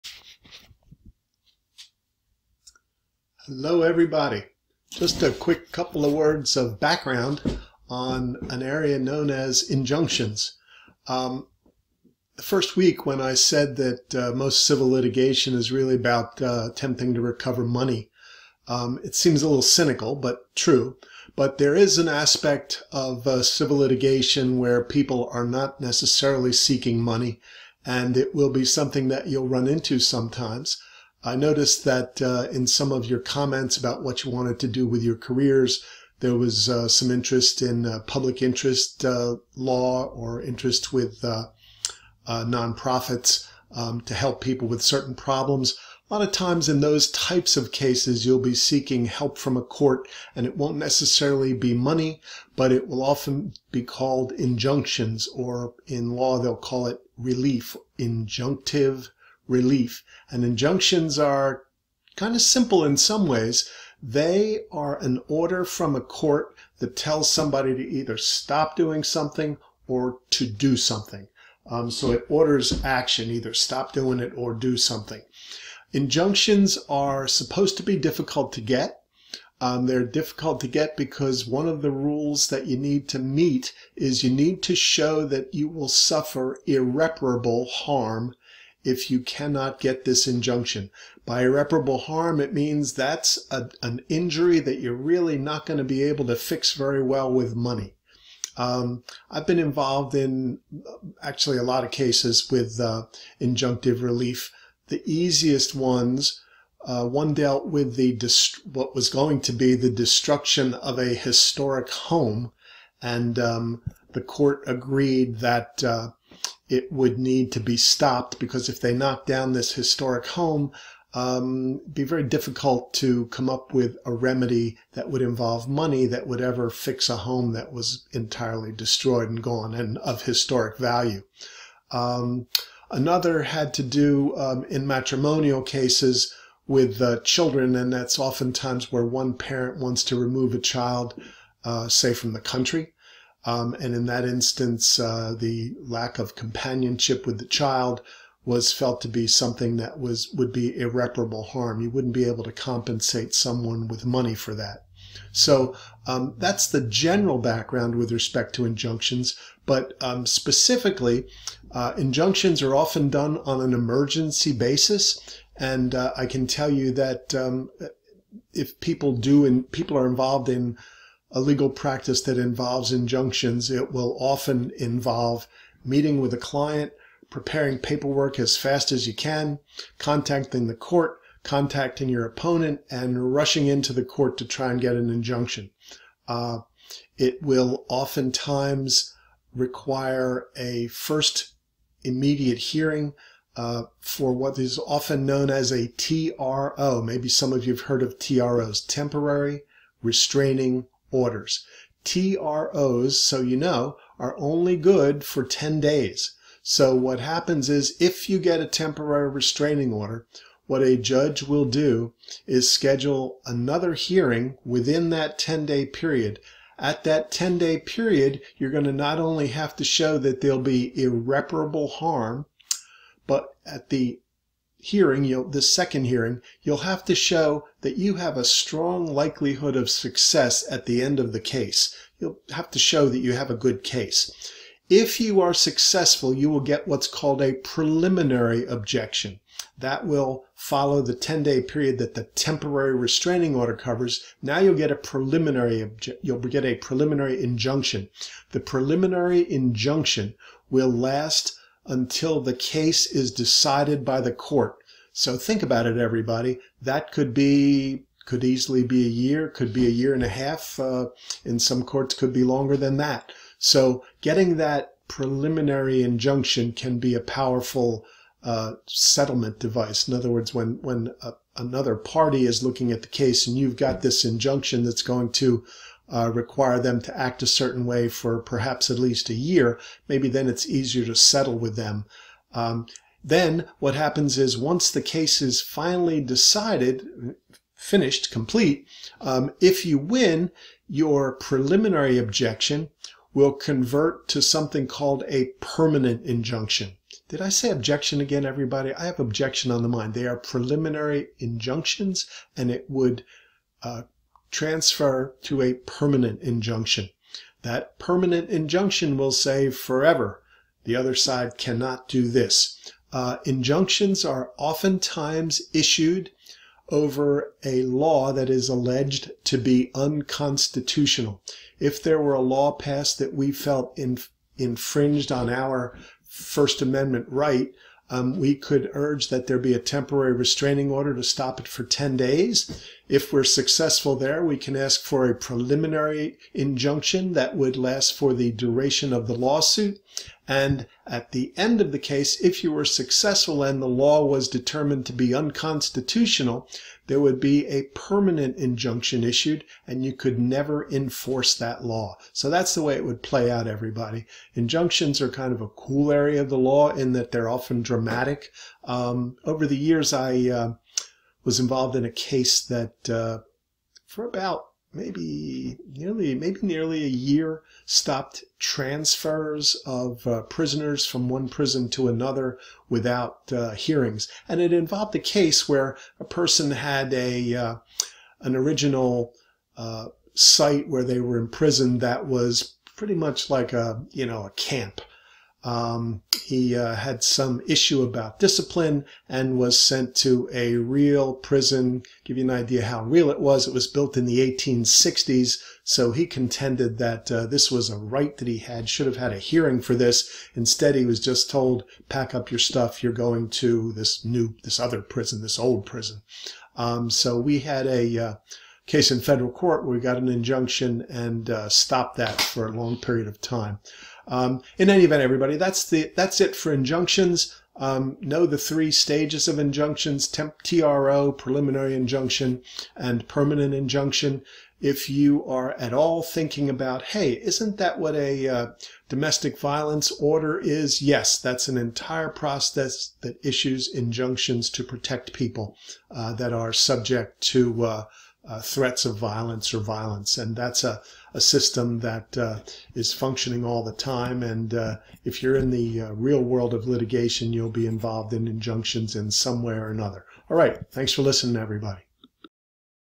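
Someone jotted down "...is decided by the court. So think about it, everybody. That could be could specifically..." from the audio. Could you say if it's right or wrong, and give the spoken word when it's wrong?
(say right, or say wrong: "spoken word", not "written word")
wrong: "easily", not "specifically".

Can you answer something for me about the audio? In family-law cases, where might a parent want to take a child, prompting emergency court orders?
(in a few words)
the country.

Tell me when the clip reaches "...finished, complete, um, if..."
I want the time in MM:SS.
04:47.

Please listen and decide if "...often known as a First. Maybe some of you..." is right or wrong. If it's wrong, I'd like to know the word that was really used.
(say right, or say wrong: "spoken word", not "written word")
wrong: "TRO", not "First".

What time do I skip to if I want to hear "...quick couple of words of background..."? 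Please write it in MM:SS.
00:05.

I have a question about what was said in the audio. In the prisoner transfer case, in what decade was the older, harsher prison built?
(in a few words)
1860s.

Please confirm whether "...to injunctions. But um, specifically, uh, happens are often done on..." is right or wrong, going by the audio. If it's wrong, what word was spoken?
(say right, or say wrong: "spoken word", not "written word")
wrong: "injunctions", not "happens".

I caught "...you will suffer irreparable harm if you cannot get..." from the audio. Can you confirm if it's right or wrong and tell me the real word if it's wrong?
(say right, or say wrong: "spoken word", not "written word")
right.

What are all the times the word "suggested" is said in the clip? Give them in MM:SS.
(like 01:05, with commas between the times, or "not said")
not said.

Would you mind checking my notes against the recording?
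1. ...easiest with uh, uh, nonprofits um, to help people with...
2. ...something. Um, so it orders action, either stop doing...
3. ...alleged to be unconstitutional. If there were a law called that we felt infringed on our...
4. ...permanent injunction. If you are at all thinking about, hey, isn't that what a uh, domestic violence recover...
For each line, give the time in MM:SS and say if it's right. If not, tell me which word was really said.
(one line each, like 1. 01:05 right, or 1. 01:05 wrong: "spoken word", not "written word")
1. 00:40 wrong: "interest", not "easiest"
2. 01:10 right
3. 05:18 wrong: "passed", not "called"
4. 07:03 wrong: "order", not "recover".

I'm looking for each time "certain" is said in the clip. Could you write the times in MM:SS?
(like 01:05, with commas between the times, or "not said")
00:44, 04:37.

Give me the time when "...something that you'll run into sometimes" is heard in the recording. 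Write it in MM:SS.
00:28.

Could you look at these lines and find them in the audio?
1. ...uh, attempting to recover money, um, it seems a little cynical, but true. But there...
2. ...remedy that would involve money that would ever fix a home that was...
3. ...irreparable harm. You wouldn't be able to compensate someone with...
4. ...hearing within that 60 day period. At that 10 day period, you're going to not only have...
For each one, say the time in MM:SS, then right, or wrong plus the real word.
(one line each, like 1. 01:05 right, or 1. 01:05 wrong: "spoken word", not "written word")
1. 00:16 right
2. 02:04 right
3. 02:30 right
4. 03:33 wrong: "10", not "60".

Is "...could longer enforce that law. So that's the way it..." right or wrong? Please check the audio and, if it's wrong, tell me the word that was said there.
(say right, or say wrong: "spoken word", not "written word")
wrong: "never", not "longer".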